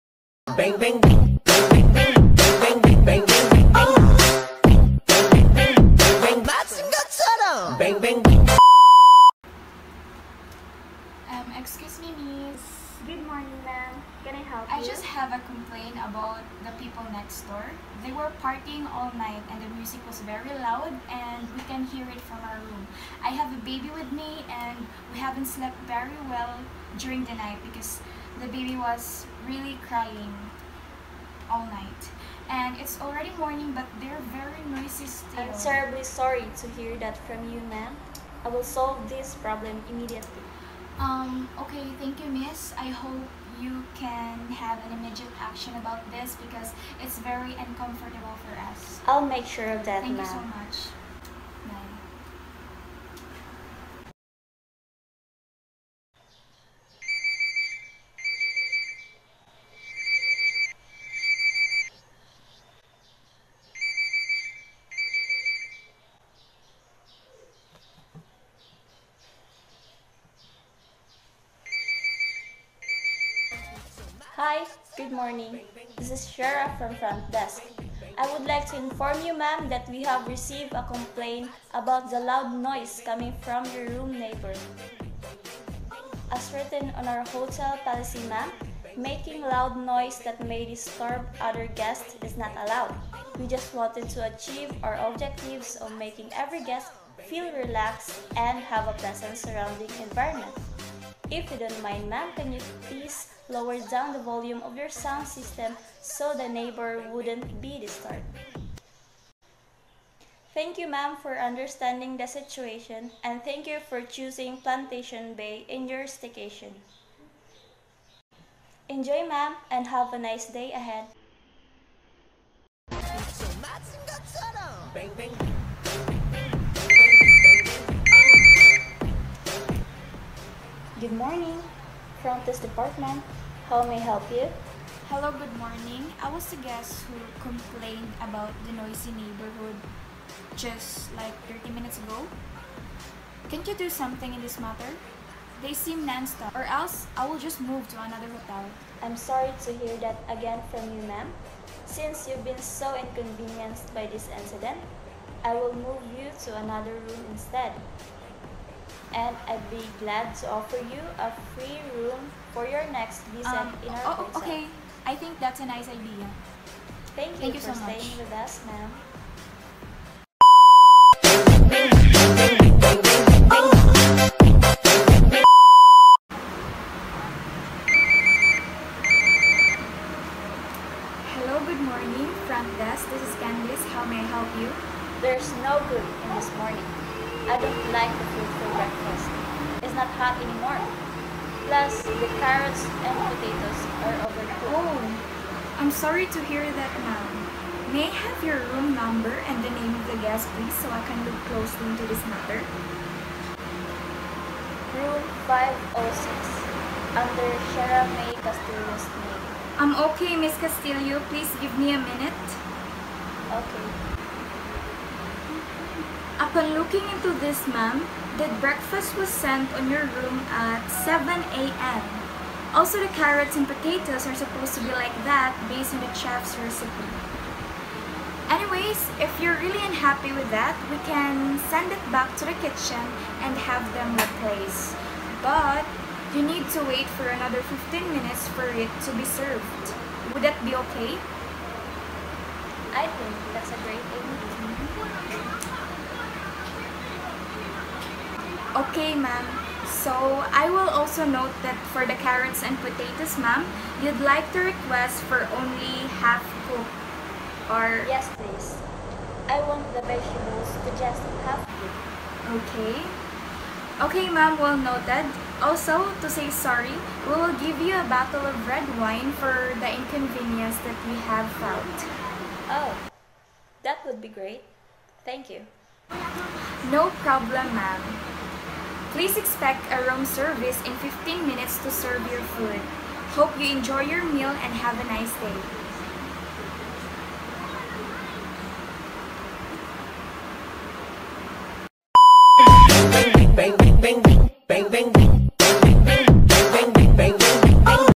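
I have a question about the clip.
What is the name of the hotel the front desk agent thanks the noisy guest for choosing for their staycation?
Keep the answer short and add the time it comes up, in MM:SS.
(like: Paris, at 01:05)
Plantation Bay, at 01:54.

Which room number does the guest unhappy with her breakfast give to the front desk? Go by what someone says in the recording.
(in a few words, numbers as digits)
506.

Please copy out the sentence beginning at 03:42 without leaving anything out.
Also, the carrots and potatoes are supposed to be like that based on the chef's recipe.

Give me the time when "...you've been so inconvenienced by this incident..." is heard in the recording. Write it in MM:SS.
02:32.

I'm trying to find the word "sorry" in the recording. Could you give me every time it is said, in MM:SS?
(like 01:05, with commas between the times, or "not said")
00:36, 02:29, 03:15, 04:26.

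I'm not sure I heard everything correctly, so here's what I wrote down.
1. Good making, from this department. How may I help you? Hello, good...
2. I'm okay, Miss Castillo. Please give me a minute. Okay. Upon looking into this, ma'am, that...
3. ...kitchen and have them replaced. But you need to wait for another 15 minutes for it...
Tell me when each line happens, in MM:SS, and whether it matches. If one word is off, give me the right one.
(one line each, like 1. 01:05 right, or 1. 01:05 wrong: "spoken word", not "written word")
1. 02:11 wrong: "morning", not "making"
2. 03:29 right
3. 03:52 right.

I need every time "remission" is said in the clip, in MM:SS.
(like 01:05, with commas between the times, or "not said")
not said.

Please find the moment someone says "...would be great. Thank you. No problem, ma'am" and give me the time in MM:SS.
04:34.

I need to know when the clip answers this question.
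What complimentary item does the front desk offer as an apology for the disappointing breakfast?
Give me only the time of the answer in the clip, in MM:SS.
04:28.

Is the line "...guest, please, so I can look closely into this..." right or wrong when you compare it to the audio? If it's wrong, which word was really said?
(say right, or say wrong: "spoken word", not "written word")
right.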